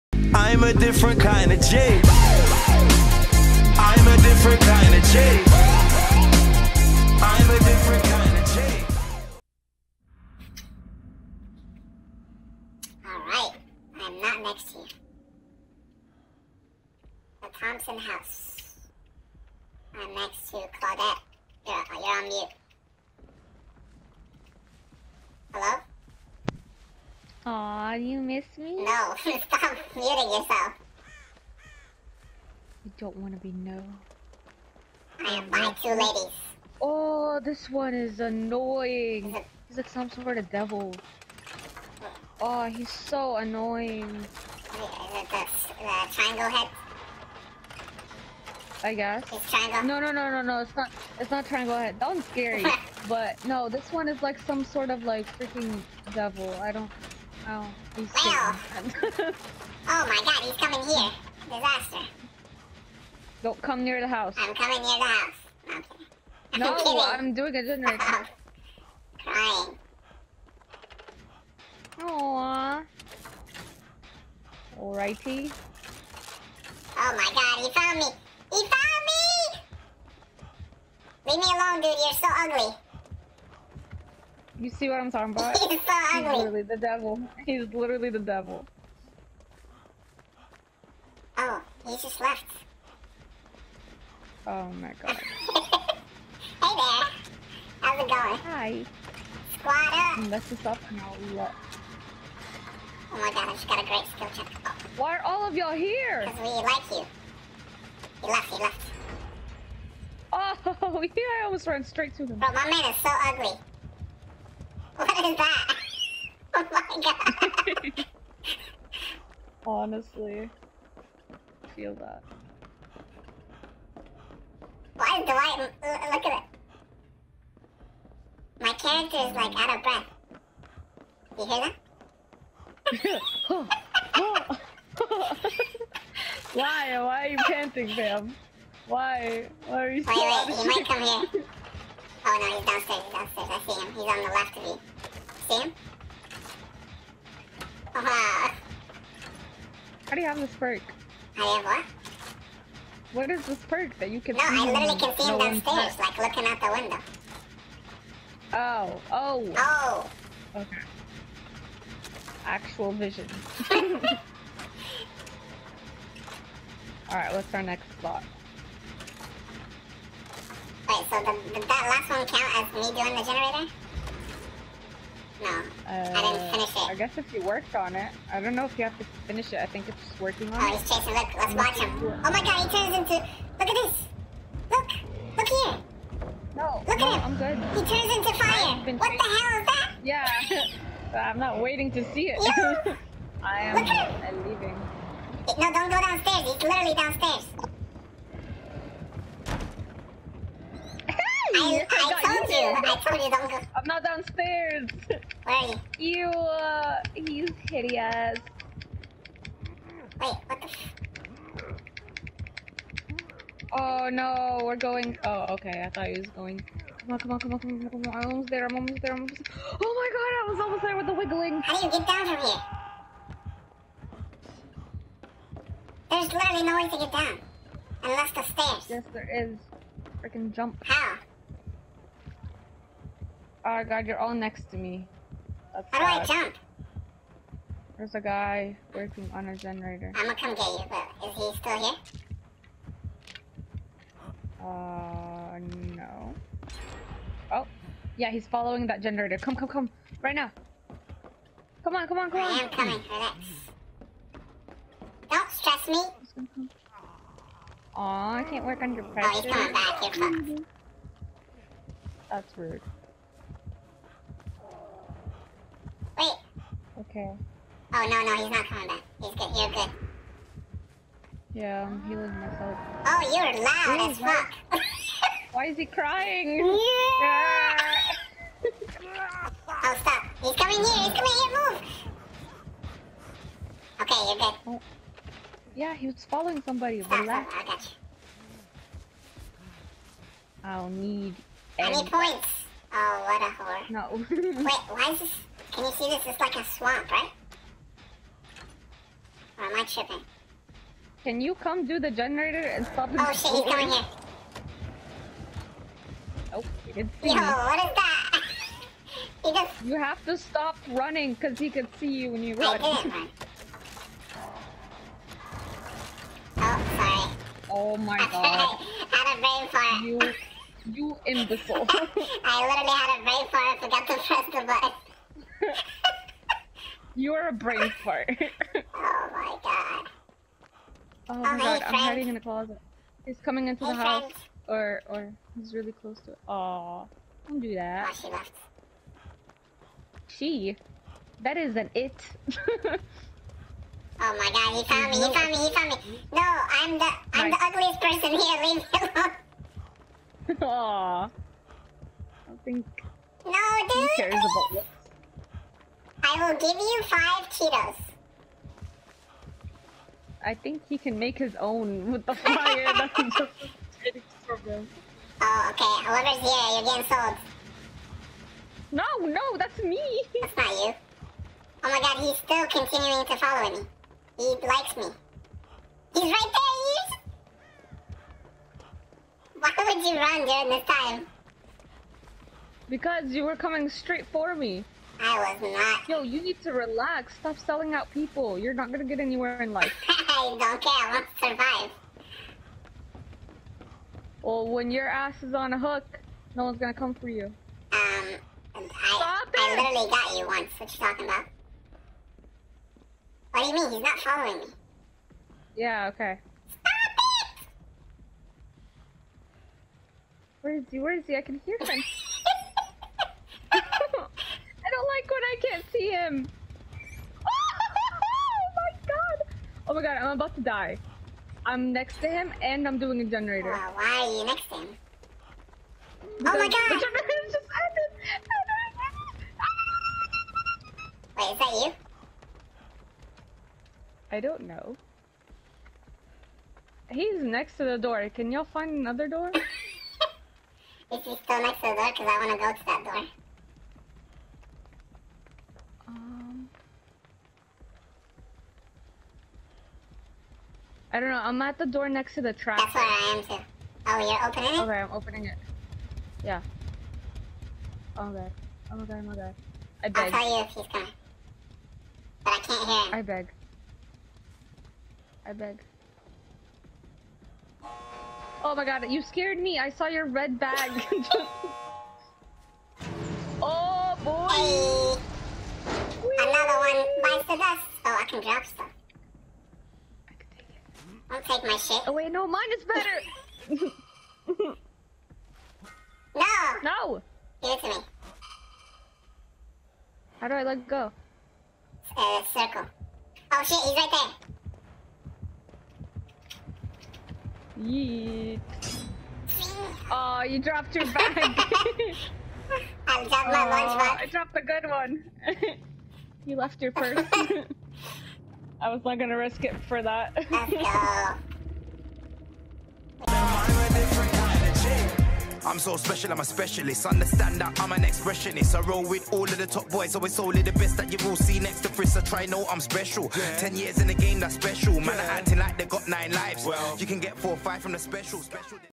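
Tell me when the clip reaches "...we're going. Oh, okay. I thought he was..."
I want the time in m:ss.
3:34.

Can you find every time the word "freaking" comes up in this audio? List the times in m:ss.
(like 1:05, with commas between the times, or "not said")
0:55, 3:50.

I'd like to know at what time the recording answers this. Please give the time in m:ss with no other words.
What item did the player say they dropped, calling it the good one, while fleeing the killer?
8:23.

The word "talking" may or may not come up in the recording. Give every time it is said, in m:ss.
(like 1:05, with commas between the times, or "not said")
1:25, 6:41.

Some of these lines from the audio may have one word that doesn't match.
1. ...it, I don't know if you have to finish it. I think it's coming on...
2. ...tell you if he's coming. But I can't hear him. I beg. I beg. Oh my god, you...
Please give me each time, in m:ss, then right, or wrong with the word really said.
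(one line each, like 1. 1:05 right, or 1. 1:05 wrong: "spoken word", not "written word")
1. 2:57 wrong: "working", not "coming"
2. 7:40 right.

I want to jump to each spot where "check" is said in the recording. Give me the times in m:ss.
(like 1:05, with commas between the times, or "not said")
1:44.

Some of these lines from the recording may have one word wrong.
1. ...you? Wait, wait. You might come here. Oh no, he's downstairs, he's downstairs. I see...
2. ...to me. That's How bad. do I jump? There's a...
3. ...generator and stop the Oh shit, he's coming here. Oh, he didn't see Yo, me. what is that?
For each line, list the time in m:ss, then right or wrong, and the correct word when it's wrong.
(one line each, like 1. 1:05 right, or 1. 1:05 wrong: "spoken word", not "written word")
1. 2:19 right
2. 3:54 right
3. 5:02 right.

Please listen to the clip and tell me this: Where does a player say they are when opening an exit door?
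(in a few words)
Next to the trap.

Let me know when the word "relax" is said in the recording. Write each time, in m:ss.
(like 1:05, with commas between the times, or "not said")
4:13, 4:47, 6:26.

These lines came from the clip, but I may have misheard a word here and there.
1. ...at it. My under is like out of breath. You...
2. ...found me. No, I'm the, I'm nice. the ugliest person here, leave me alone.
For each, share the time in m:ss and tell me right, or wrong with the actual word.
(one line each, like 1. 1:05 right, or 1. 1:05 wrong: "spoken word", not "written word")
1. 2:06 wrong: "character", not "under"
2. 5:45 right.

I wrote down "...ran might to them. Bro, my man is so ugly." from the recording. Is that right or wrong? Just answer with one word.
wrong.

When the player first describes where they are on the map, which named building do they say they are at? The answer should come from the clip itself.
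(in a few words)
The Thompson House.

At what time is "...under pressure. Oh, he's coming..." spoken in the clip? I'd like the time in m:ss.
4:18.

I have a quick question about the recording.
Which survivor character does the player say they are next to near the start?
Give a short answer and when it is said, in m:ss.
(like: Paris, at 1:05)
Claudette, at 0:20.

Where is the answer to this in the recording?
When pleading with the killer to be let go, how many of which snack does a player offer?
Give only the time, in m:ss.
5:57.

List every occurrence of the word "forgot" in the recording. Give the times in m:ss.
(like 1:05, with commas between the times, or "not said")
5:23.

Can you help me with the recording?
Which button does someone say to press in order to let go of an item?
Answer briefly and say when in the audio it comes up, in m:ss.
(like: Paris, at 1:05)
Circle, at 8:12.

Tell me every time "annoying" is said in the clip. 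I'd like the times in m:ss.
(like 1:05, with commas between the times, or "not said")
0:38, 0:43.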